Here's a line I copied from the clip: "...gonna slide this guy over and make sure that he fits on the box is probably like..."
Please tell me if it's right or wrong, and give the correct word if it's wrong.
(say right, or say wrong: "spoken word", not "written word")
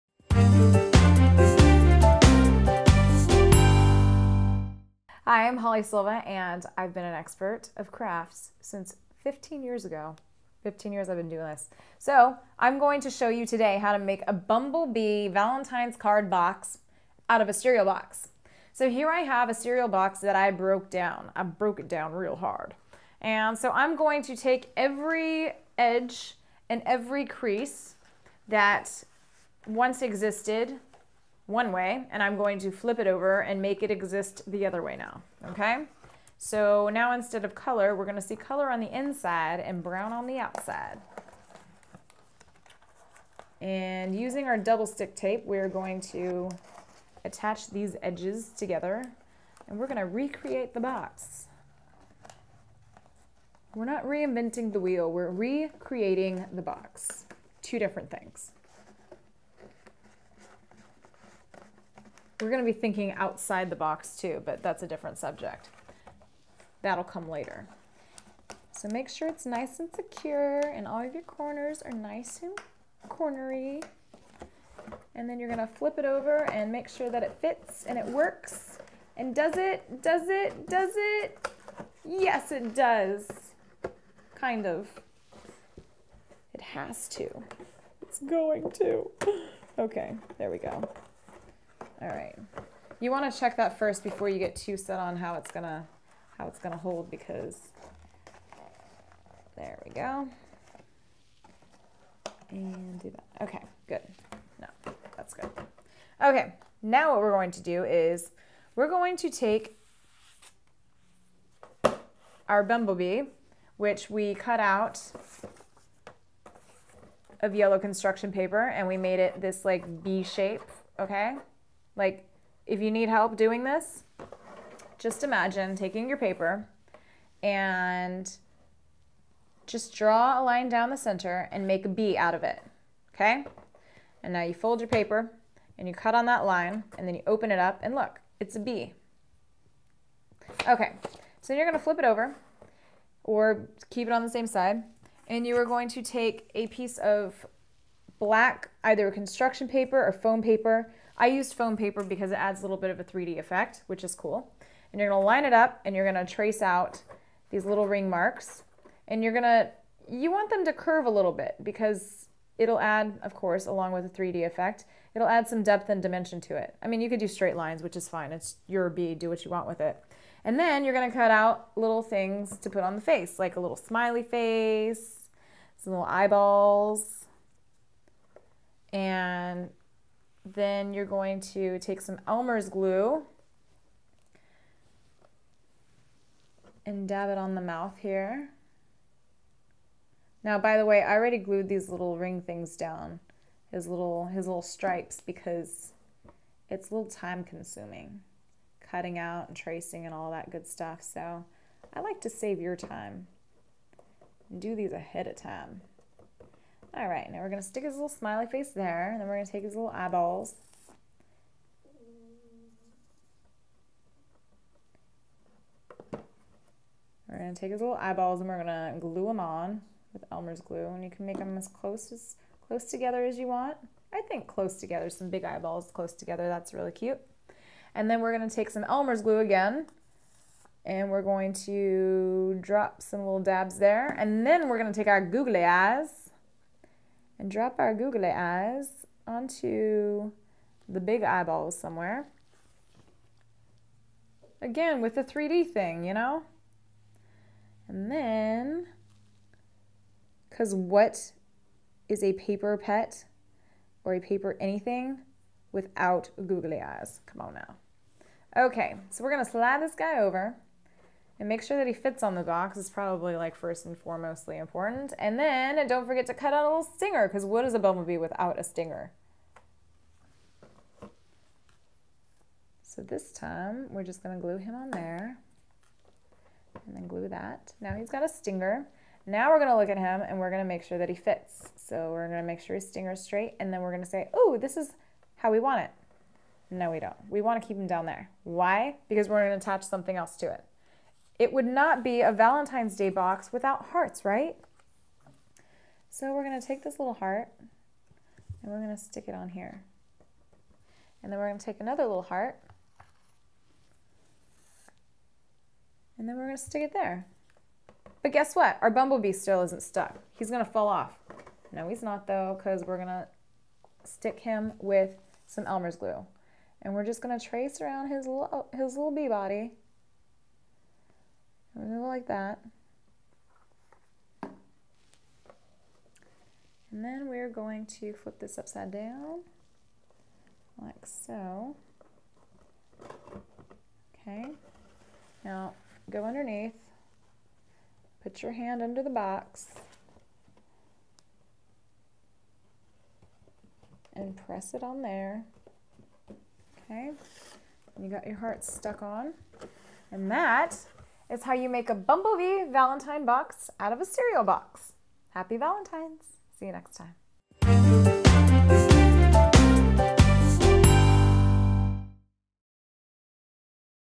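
right.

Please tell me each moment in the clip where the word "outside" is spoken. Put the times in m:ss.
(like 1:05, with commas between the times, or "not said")
0:40, 1:03.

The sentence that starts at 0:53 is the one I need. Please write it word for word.
We're not reinventing the wheel, we're recreating the box.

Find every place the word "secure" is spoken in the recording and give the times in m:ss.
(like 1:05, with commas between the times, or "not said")
1:09.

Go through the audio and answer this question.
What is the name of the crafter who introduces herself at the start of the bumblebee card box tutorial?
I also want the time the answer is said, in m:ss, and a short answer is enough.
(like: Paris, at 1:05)
Holly Silva, at 0:05.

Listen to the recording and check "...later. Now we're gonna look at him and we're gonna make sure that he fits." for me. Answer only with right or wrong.
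wrong.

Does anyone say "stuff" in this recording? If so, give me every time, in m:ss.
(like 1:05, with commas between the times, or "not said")
3:20.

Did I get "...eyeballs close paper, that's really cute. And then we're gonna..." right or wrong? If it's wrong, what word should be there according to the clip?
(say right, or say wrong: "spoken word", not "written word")
wrong: "together", not "paper".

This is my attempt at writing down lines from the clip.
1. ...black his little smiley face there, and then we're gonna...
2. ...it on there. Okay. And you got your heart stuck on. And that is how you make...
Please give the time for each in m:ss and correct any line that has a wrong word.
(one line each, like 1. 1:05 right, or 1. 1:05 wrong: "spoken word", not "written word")
1. 3:27 wrong: "stick", not "black"
2. 5:44 right.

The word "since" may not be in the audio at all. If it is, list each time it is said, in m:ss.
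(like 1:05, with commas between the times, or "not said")
0:08.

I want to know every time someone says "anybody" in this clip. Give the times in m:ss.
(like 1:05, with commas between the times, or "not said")
not said.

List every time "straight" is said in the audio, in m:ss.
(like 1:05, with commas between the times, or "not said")
2:47, 4:43.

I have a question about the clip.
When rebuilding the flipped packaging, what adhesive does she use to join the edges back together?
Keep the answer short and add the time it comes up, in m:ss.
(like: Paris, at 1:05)
Double stick tape, at 0:44.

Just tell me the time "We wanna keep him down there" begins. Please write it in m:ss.
4:47.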